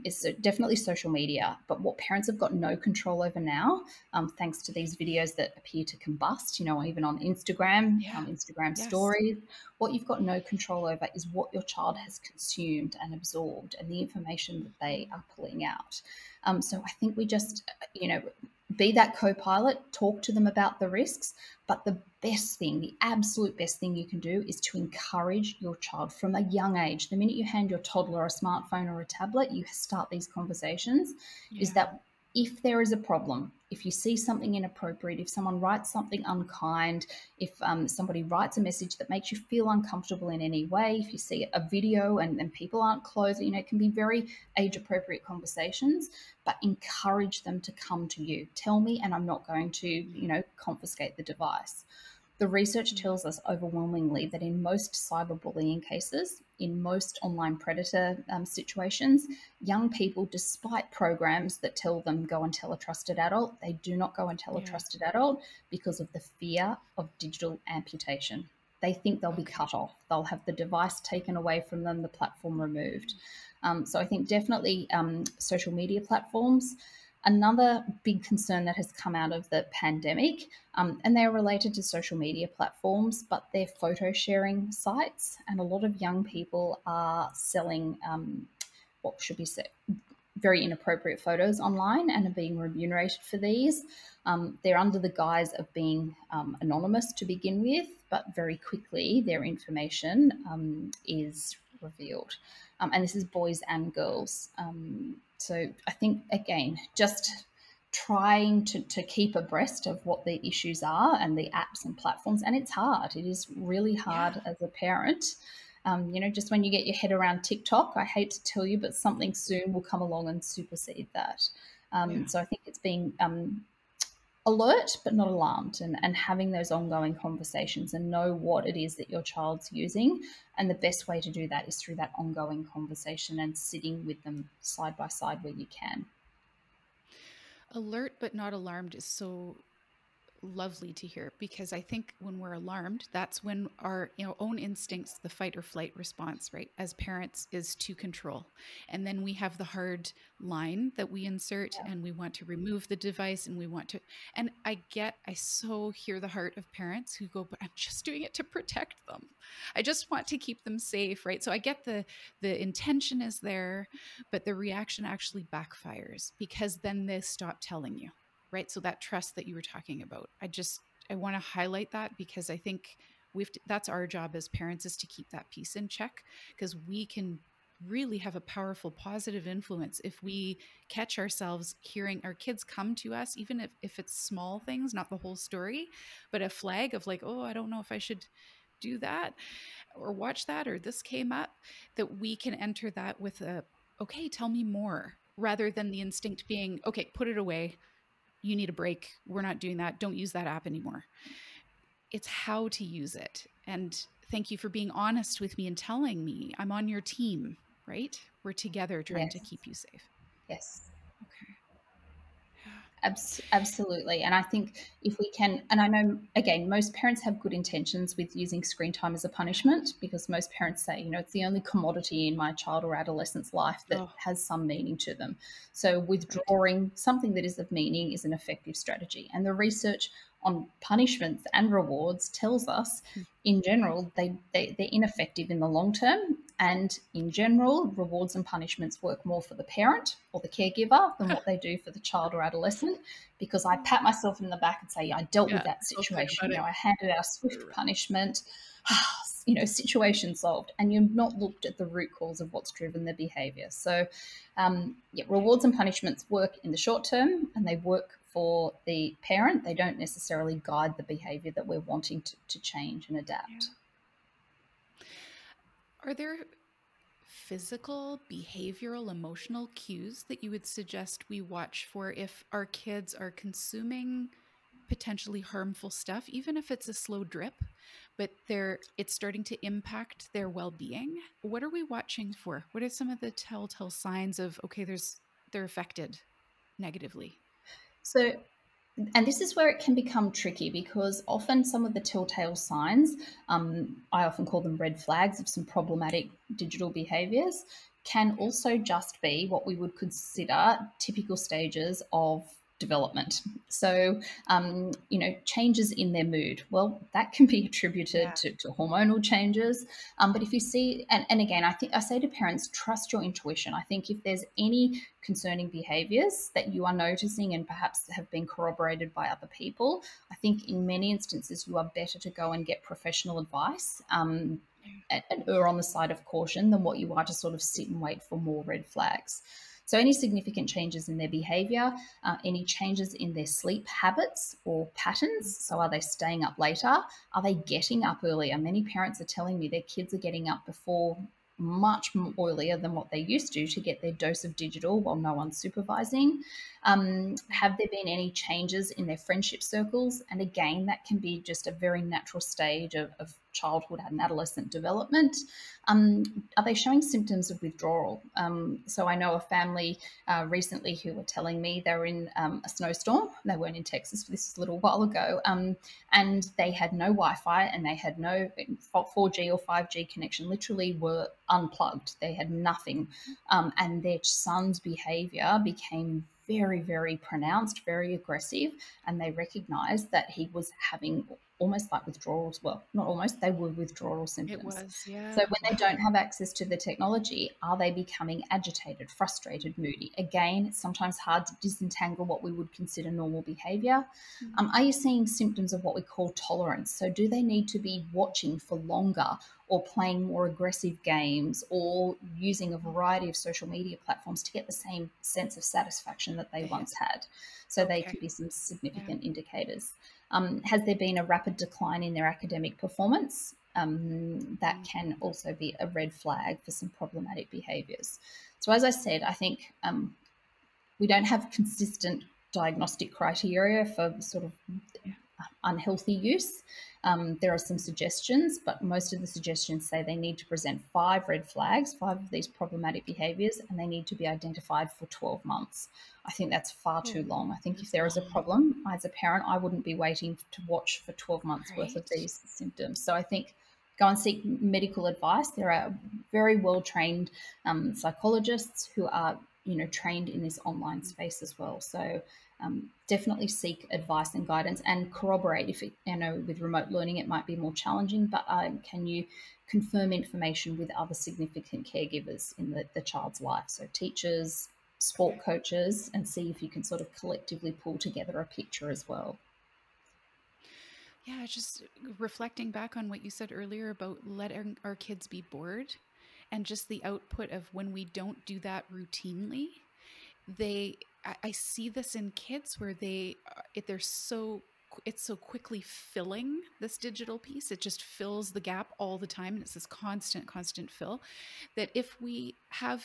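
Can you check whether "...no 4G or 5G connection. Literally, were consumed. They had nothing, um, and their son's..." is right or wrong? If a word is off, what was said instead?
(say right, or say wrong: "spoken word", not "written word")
wrong: "unplugged", not "consumed".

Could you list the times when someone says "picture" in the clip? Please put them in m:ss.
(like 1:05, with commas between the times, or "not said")
7:48.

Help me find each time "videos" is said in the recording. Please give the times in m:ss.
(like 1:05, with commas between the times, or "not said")
0:04, 0:41.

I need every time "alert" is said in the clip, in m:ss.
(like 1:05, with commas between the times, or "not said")
2:04, 2:17.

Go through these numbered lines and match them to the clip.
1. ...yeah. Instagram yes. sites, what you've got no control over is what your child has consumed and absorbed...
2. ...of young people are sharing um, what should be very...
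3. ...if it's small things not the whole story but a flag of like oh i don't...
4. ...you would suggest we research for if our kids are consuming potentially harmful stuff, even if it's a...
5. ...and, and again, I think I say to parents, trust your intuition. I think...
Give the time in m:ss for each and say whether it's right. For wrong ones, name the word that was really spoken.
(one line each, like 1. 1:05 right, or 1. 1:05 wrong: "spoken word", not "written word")
1. 0:07 wrong: "stories", not "sites"
2. 1:25 wrong: "selling", not "sharing"
3. 3:03 right
4. 4:30 wrong: "watch", not "research"
5. 5:11 right.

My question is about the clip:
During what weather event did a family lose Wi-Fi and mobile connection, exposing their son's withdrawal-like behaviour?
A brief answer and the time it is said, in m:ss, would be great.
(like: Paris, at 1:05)
a snowstorm, at 6:02.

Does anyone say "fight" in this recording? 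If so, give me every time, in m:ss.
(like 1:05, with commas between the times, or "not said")
2:25.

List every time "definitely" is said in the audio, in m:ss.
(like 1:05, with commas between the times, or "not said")
0:00, 1:14, 7:33.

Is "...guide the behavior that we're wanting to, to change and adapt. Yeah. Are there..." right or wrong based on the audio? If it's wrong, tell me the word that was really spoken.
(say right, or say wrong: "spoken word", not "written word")
right.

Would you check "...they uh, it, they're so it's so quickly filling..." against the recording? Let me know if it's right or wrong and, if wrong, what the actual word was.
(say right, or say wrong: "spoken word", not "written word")
right.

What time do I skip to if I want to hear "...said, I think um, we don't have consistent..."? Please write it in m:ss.
6:58.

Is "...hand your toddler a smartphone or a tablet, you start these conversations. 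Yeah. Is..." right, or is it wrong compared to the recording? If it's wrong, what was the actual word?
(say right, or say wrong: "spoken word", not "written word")
right.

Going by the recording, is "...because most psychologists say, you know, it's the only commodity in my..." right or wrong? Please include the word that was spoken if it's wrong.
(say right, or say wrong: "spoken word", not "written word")
wrong: "parents", not "psychologists".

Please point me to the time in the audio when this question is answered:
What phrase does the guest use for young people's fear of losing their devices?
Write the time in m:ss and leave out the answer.
1:07.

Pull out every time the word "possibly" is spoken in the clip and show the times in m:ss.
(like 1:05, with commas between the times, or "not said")
not said.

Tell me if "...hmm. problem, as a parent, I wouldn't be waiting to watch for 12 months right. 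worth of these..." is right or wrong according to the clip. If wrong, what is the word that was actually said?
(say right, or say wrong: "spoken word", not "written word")
right.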